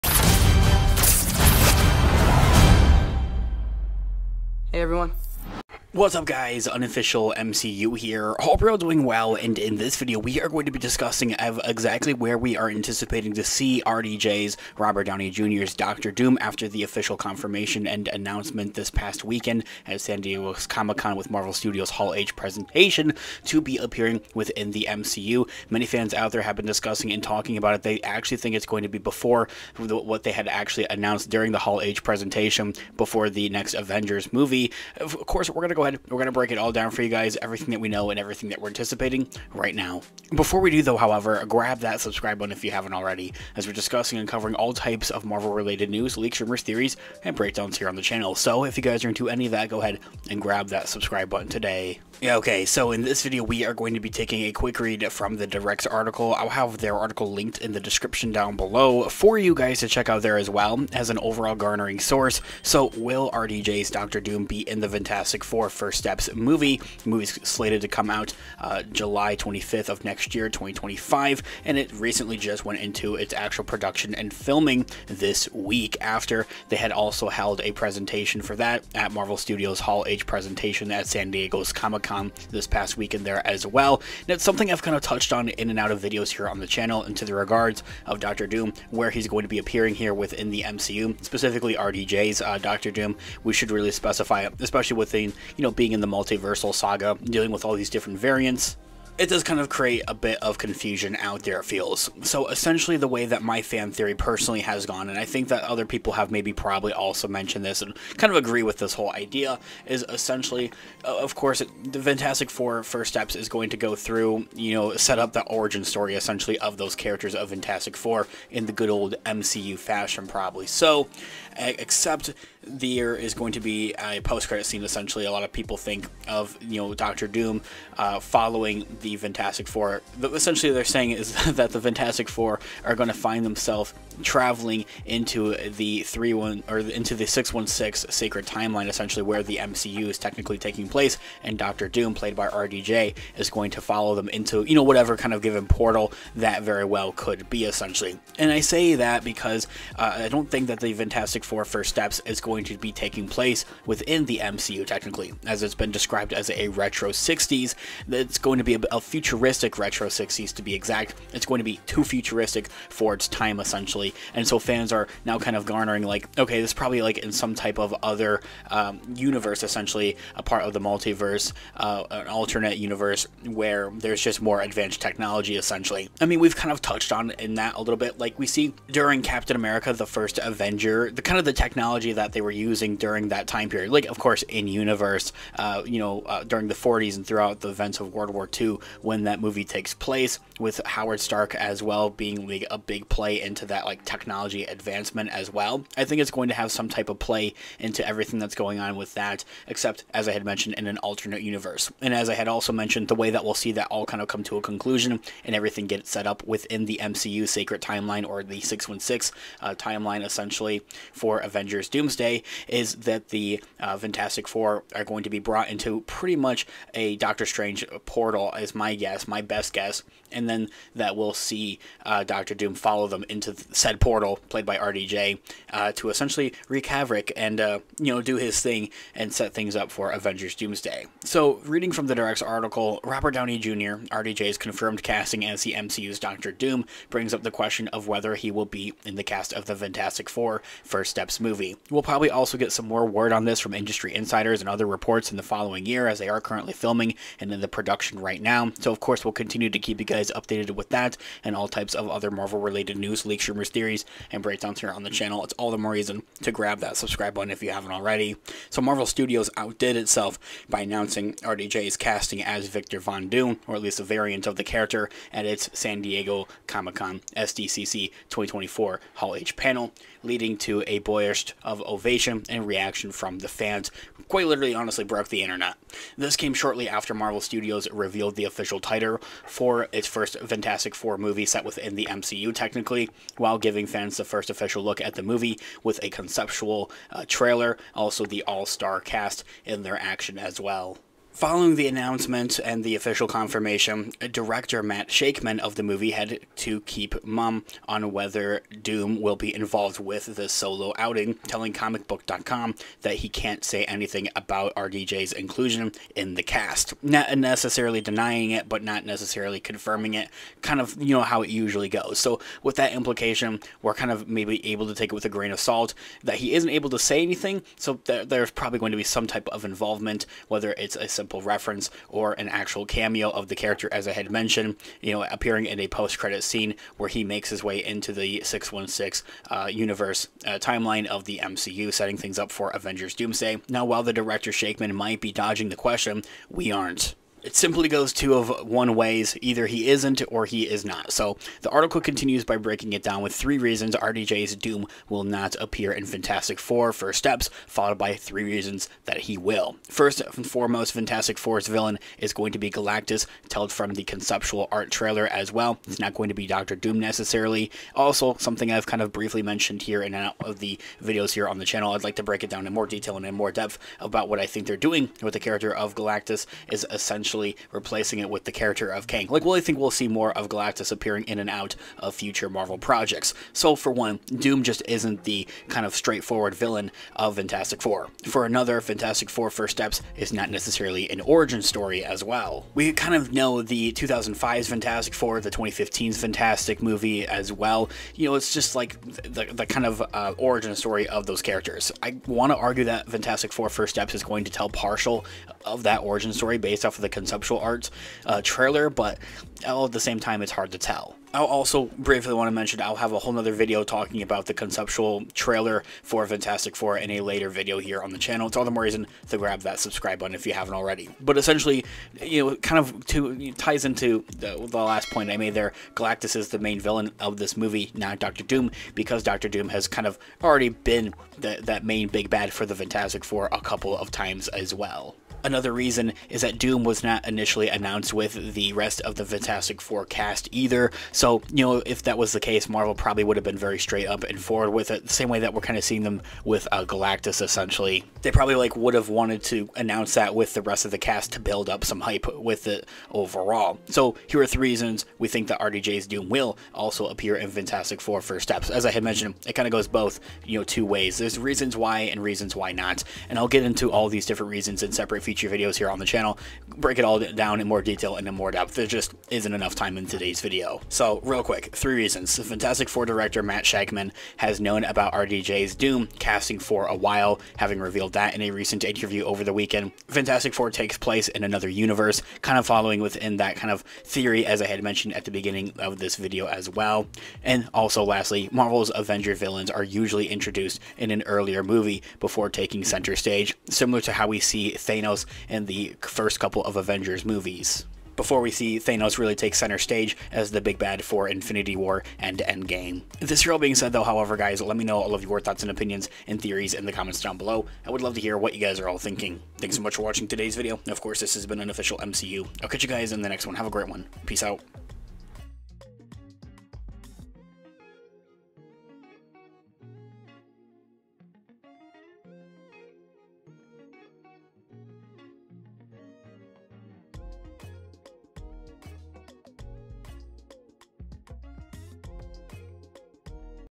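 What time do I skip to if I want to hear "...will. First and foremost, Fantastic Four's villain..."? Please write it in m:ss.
5:49.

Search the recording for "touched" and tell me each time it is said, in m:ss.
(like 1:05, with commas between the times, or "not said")
1:25, 2:56.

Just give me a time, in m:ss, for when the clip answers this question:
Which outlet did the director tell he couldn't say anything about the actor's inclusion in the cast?
5:01.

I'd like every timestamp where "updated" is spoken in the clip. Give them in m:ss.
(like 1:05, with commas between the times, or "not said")
4:10.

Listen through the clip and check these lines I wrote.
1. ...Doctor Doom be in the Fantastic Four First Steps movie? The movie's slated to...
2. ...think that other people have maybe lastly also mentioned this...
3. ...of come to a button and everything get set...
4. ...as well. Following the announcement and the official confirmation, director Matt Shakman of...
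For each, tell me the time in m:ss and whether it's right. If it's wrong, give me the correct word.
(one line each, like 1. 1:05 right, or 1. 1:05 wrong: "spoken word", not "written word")
1. 1:03 right
2. 1:45 wrong: "probably", not "lastly"
3. 3:24 wrong: "conclusion", not "button"
4. 4:50 right.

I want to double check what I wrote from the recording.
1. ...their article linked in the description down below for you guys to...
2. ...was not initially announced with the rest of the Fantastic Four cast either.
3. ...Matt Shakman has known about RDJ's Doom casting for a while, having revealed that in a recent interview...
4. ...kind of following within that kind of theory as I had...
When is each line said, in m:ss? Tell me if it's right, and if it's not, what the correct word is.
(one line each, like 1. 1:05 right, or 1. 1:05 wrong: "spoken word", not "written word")
1. 0:56 right
2. 7:06 right
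3. 7:43 right
4. 7:52 right.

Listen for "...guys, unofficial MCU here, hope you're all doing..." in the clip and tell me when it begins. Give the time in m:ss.
0:06.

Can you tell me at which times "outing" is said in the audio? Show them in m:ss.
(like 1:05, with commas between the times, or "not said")
5:00.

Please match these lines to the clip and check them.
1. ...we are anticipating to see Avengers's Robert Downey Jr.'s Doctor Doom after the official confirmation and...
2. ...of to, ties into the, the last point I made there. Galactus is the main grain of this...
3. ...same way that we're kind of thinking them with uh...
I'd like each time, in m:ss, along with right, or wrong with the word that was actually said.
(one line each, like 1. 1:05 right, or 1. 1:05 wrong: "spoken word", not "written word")
1. 0:12 wrong: "RDJ", not "Avengers"
2. 6:52 wrong: "villain", not "grain"
3. 7:15 wrong: "seeing", not "thinking".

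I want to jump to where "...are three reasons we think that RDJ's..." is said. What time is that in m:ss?
7:24.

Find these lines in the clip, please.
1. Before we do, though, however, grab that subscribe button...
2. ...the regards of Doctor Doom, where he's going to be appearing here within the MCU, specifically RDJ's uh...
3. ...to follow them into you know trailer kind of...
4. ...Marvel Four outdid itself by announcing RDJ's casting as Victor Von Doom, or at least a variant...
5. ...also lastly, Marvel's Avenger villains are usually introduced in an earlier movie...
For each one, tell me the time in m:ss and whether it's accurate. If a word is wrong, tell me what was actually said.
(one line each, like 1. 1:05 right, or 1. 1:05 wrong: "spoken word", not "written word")
1. 0:40 right
2. 1:27 right
3. 2:23 wrong: "whatever", not "trailer"
4. 4:18 wrong: "Studios", not "Four"
5. 7:57 right.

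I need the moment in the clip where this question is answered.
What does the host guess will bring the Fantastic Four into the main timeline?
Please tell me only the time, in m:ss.
3:37.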